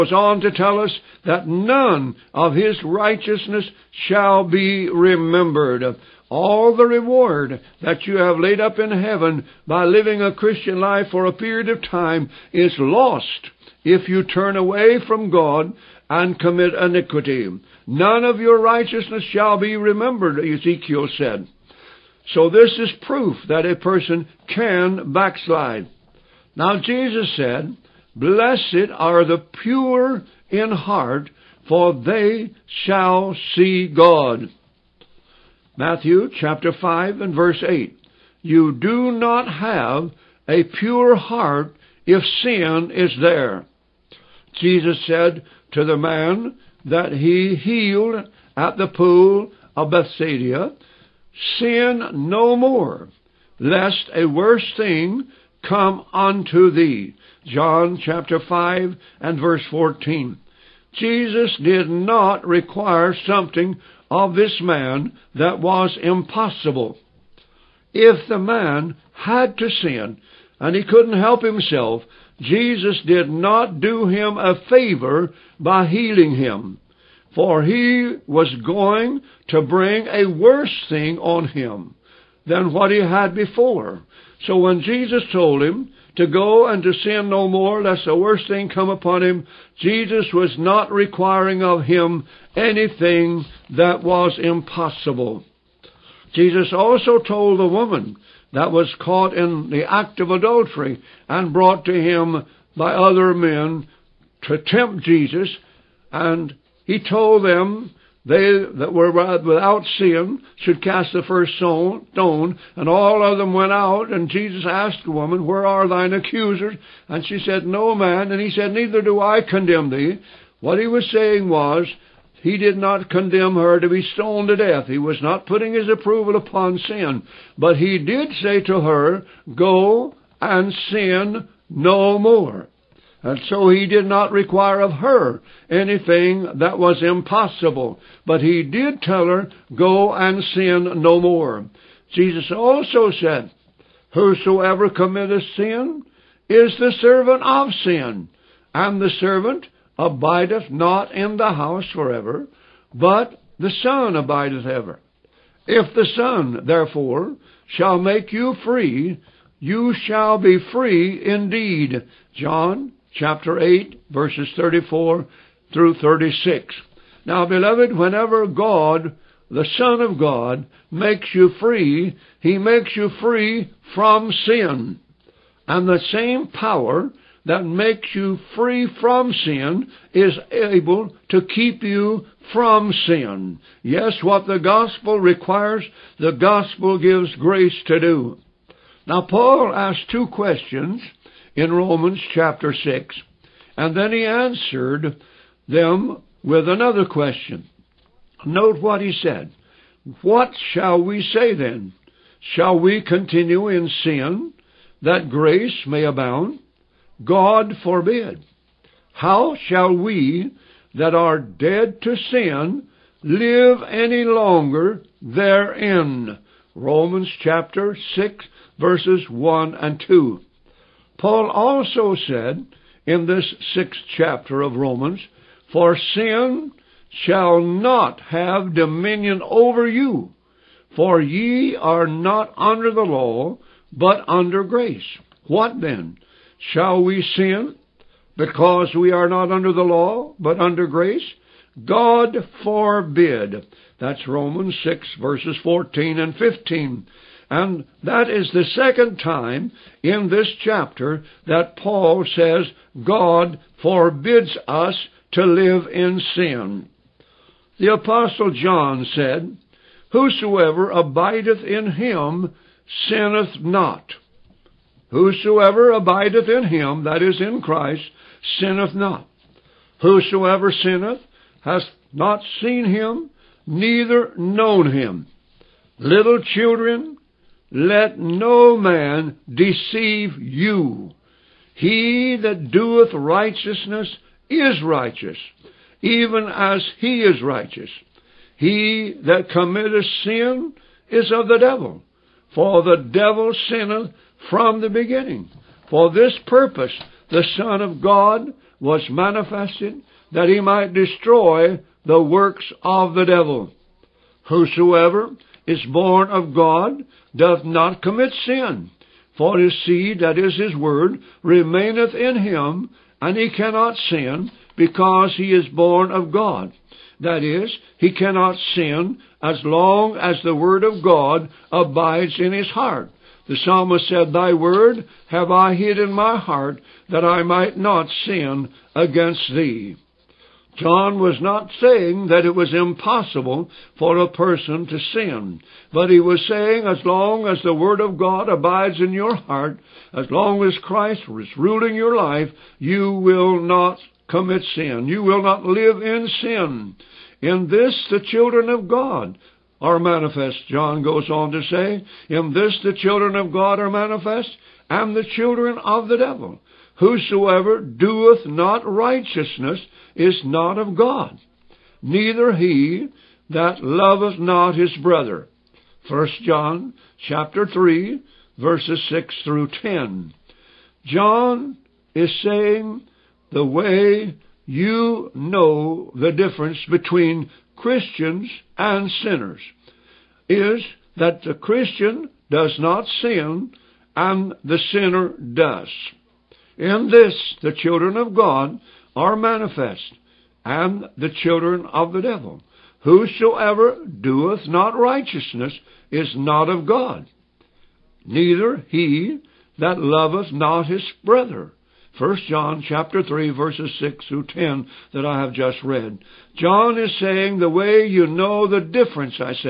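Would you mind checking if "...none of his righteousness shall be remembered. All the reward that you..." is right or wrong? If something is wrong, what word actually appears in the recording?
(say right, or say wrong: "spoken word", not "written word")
right.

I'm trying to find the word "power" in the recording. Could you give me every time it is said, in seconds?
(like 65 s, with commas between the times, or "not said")
176 s.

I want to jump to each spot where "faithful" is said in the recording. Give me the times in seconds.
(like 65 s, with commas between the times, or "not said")
not said.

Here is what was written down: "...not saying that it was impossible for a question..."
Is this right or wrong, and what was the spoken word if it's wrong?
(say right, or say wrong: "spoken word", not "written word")
wrong: "person", not "question".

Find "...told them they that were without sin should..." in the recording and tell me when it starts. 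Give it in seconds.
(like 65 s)
107 s.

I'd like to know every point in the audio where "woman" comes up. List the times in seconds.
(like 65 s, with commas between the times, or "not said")
97 s, 115 s.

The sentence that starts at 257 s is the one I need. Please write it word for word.
The Apostle John said, Whosoever abideth in him sinneth not.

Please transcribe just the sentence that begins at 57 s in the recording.
John chapter 5 and verse 14.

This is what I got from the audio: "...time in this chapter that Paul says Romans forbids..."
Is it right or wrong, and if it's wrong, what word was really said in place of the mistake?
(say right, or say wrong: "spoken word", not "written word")
wrong: "God", not "Romans".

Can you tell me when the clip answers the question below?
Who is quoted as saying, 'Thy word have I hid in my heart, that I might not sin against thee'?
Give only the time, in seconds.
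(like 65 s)
323 s.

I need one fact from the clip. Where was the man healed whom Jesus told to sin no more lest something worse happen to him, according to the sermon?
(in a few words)
Pool of Bethsaida.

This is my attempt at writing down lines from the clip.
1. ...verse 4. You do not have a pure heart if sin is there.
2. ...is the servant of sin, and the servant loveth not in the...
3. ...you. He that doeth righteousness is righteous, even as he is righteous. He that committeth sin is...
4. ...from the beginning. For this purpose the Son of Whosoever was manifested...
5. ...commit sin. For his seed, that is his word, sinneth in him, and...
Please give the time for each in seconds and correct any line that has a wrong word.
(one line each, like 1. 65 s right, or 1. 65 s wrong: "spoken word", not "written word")
1. 37 s wrong: "8", not "4"
2. 146 s wrong: "abideth", not "loveth"
3. 280 s right
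4. 294 s wrong: "God", not "Whosoever"
5. 308 s wrong: "remaineth", not "sinneth".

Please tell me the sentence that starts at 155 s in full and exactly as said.
If the Son, therefore, shall make you free, you shall be free indeed.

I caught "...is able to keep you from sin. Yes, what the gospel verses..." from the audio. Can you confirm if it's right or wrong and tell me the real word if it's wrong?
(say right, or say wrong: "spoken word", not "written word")
wrong: "requires", not "verses".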